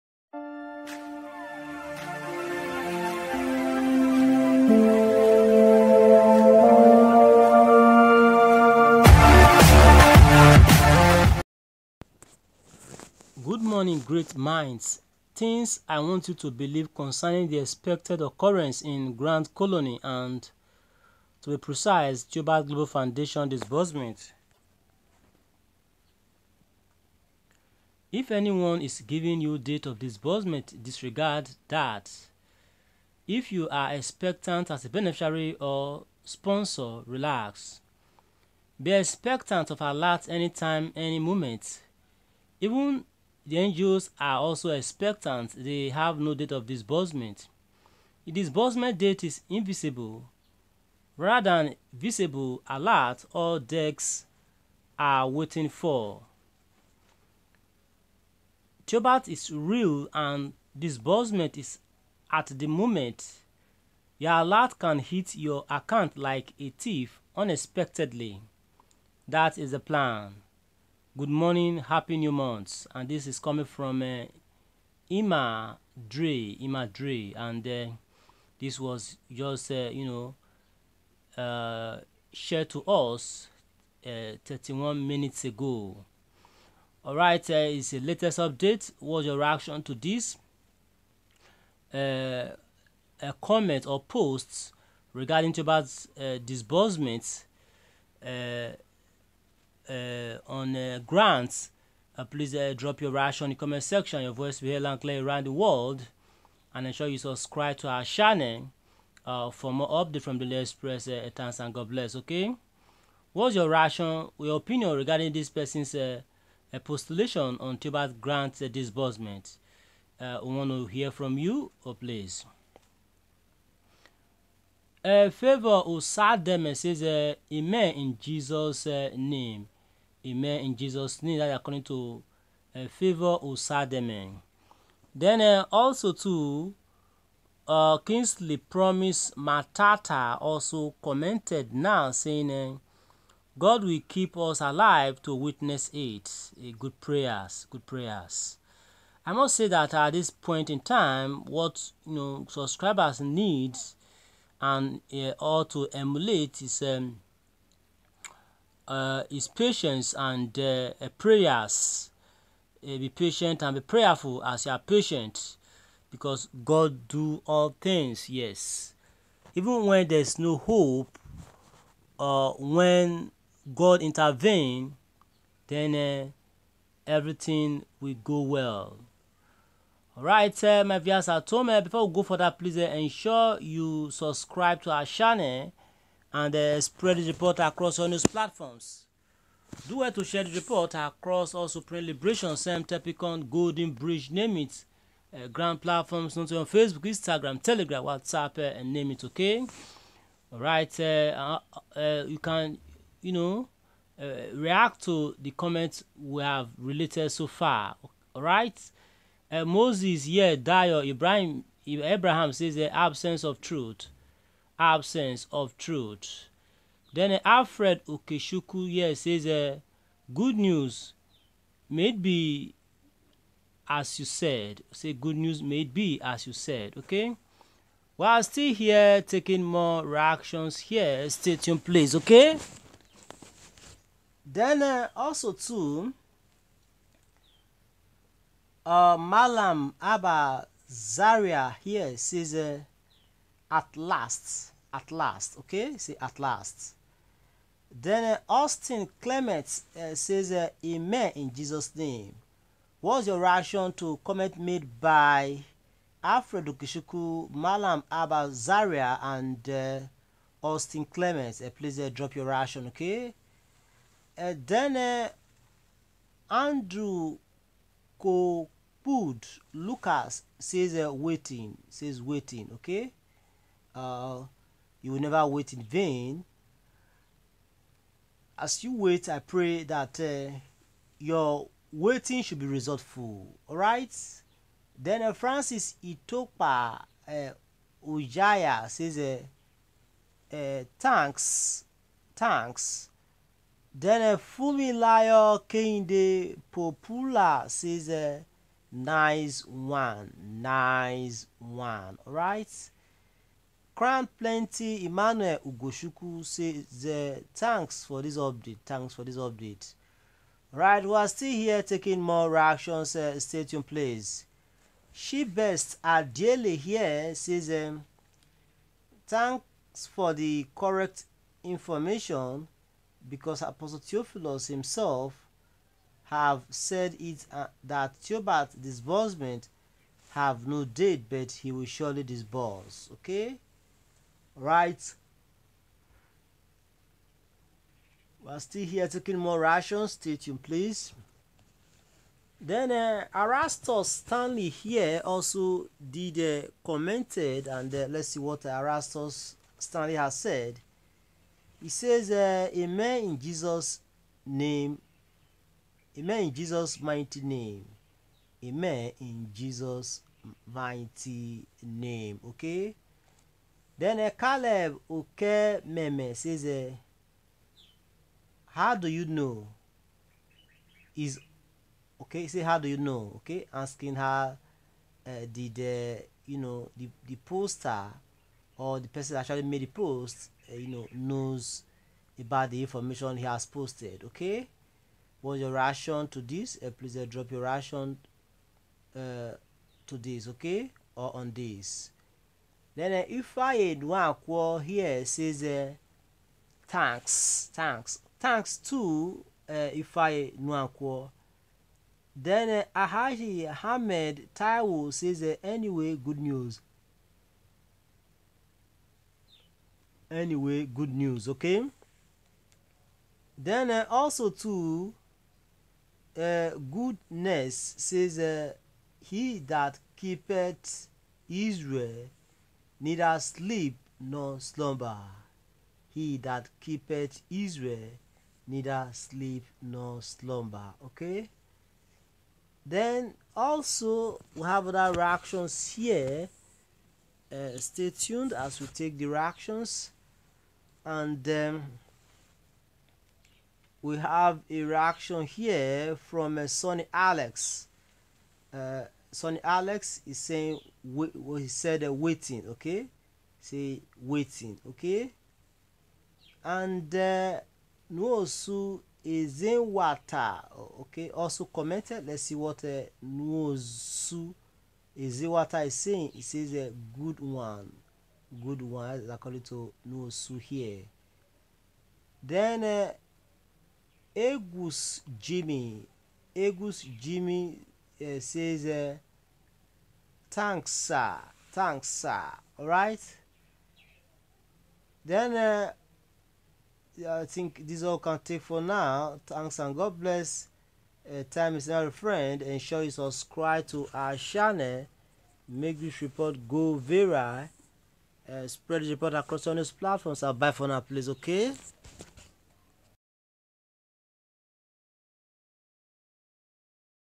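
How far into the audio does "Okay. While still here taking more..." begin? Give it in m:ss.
3:46.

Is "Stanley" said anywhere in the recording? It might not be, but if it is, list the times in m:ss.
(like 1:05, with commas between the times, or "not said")
5:44, 5:49.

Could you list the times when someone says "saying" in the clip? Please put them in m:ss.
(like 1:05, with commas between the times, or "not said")
2:22, 7:30, 7:45.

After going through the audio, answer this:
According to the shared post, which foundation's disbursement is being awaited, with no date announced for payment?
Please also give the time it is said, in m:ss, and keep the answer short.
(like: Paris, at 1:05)
Theobarth Global Foundation, at 0:22.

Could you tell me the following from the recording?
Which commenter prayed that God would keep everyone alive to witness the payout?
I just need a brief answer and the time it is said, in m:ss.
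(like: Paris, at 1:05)
Kingsley Promise Matata, at 2:17.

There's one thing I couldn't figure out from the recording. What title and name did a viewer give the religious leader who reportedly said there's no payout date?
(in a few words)
Apostle Theophilus.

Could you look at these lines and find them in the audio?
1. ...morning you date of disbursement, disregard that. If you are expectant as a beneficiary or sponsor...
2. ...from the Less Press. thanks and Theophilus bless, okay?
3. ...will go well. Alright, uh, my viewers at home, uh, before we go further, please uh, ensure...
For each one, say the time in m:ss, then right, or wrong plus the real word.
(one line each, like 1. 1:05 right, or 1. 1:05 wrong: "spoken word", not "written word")
1. 0:28 wrong: "giving", not "morning"
2. 1:50 wrong: "God", not "Theophilus"
3. 2:57 right.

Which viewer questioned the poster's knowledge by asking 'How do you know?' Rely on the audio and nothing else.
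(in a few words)
Caleb Oke Meme.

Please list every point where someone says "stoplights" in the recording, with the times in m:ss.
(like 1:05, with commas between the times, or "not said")
not said.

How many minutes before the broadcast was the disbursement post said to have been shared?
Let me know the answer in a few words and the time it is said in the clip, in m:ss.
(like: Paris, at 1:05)
31, at 1:24.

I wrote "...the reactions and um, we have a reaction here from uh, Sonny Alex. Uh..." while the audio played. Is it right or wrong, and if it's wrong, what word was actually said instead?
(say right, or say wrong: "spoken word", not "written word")
right.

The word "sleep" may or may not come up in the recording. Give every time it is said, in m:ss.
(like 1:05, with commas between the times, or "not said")
7:03, 7:09.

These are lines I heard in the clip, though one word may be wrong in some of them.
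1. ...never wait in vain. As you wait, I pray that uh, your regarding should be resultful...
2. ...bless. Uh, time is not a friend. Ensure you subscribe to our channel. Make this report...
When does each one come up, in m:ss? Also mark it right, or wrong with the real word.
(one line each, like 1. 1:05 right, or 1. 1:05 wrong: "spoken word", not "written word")
1. 4:35 wrong: "waiting", not "regarding"
2. 8:10 right.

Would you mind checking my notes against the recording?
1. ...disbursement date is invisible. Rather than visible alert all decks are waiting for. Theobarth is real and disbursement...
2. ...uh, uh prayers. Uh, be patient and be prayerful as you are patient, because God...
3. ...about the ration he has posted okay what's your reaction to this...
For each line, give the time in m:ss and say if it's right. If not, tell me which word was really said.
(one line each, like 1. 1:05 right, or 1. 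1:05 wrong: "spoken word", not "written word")
1. 0:48 right
2. 2:40 right
3. 6:22 wrong: "information", not "ration".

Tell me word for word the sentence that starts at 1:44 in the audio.
Your voice will be heard and clear around the world.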